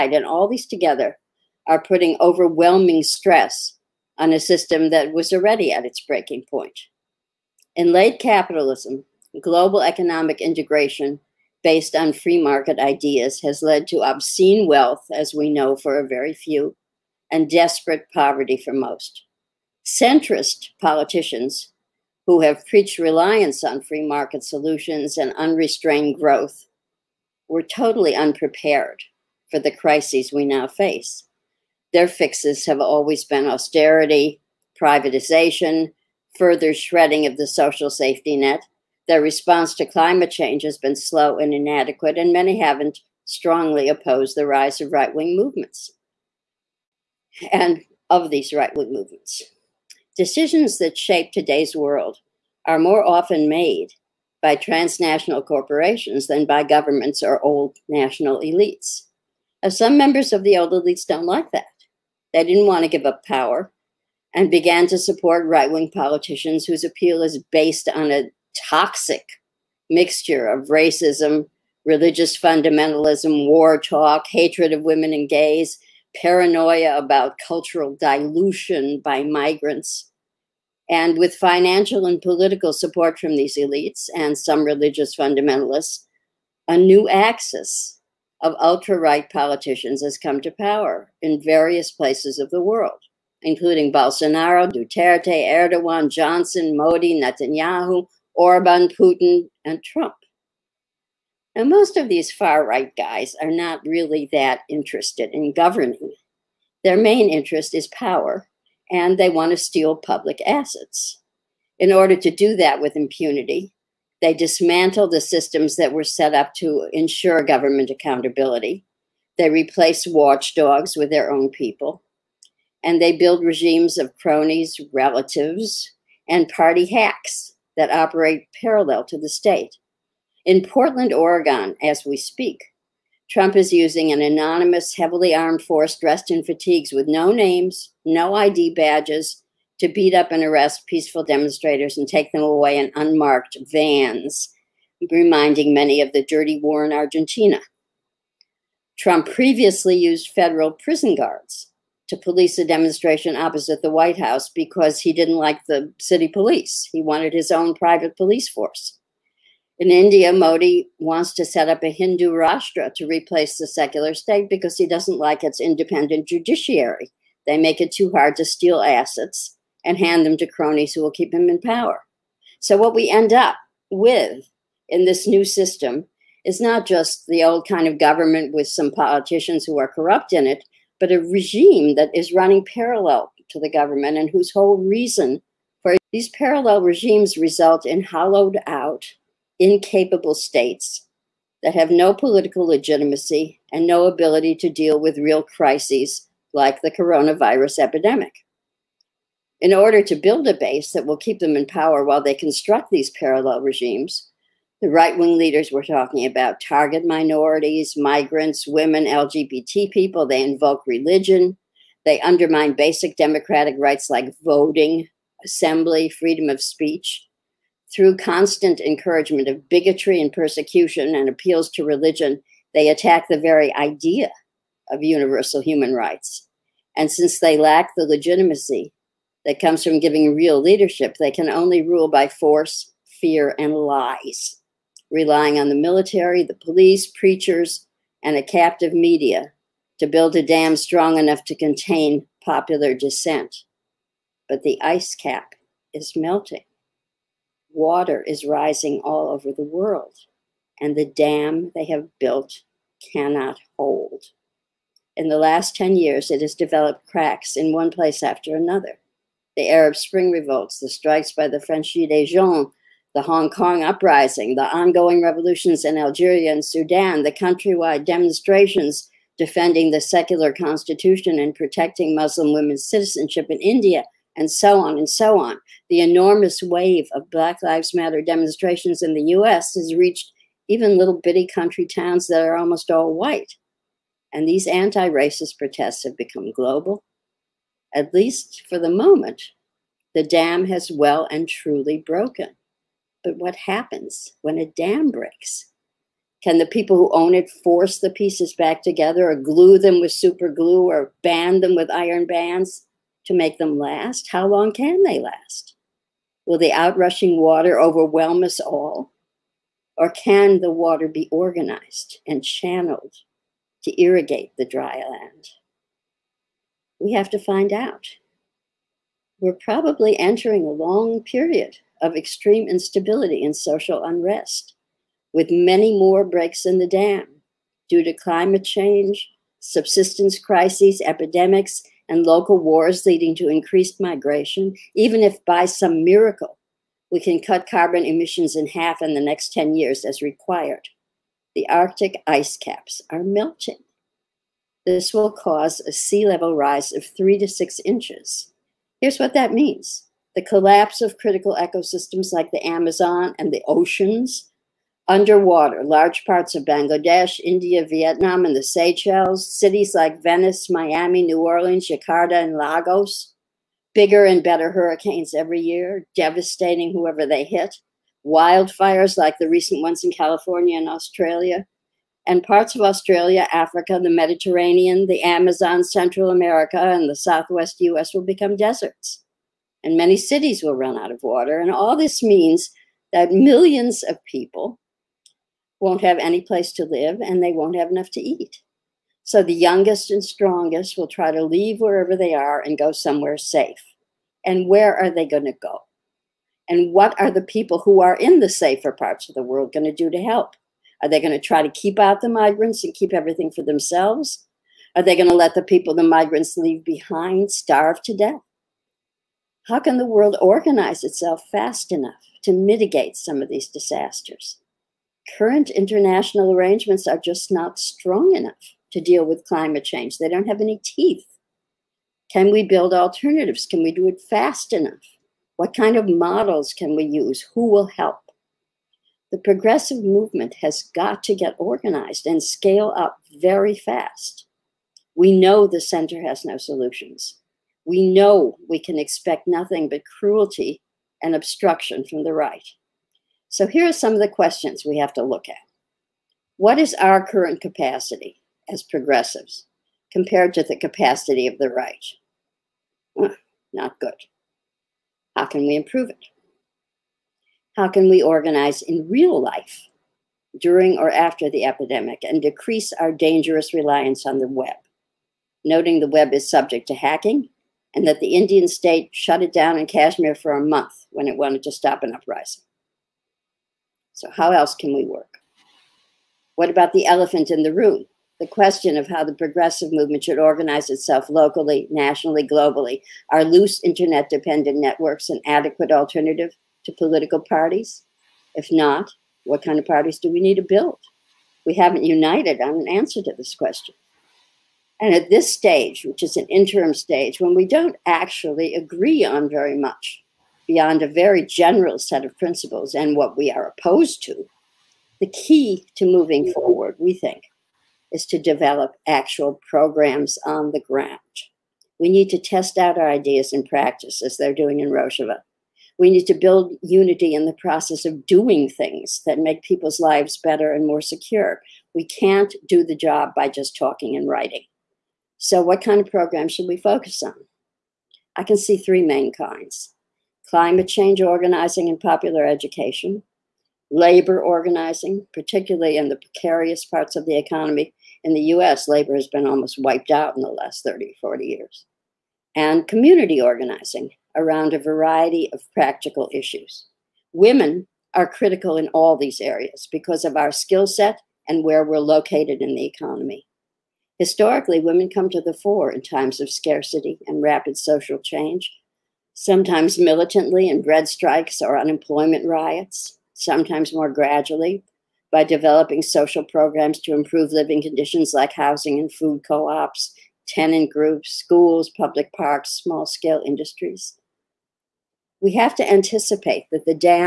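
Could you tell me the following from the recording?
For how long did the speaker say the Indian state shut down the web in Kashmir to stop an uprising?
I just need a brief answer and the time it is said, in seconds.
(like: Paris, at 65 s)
a month, at 470 s.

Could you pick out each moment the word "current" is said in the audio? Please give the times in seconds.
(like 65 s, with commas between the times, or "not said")
415 s, 447 s.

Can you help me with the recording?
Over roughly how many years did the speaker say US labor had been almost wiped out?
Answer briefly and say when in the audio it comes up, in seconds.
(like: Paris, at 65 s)
30 to 40 years, at 540 s.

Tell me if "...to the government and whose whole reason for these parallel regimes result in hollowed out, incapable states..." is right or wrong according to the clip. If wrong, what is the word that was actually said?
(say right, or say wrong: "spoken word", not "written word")
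right.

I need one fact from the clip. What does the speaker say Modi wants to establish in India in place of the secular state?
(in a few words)
a Hindu Rashtra.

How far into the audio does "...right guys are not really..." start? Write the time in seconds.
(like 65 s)
102 s.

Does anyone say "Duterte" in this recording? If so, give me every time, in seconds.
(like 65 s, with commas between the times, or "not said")
94 s.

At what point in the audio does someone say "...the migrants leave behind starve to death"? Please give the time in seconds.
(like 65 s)
405 s.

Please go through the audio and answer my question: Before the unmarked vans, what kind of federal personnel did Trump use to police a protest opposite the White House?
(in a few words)
federal prison guards.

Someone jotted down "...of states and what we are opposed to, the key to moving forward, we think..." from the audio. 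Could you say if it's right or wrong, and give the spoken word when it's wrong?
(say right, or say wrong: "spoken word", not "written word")
wrong: "principles", not "states".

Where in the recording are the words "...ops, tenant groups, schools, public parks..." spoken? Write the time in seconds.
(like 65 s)
569 s.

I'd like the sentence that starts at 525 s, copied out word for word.
So, what kind of program should we focus on?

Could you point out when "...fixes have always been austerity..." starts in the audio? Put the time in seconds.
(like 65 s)
32 s.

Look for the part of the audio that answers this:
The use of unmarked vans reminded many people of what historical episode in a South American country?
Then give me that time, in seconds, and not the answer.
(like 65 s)
146 s.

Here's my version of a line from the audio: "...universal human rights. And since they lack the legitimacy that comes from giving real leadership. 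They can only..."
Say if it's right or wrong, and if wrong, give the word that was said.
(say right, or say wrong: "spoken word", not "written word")
right.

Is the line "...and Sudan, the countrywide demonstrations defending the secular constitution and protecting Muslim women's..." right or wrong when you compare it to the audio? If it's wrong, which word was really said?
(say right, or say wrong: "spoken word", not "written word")
right.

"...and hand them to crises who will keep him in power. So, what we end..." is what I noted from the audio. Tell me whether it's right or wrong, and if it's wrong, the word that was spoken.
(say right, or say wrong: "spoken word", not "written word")
wrong: "cronies", not "crises".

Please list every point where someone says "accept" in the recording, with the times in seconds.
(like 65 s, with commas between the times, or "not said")
not said.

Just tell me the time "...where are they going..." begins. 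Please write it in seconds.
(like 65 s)
394 s.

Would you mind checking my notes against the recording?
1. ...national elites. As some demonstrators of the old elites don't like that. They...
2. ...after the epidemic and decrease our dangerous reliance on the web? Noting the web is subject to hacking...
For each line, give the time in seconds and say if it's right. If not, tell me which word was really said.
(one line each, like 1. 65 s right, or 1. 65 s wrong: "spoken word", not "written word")
1. 57 s wrong: "members", not "demonstrators"
2. 461 s right.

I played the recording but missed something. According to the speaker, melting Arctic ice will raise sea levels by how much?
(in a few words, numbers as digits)
3 to 6 inches.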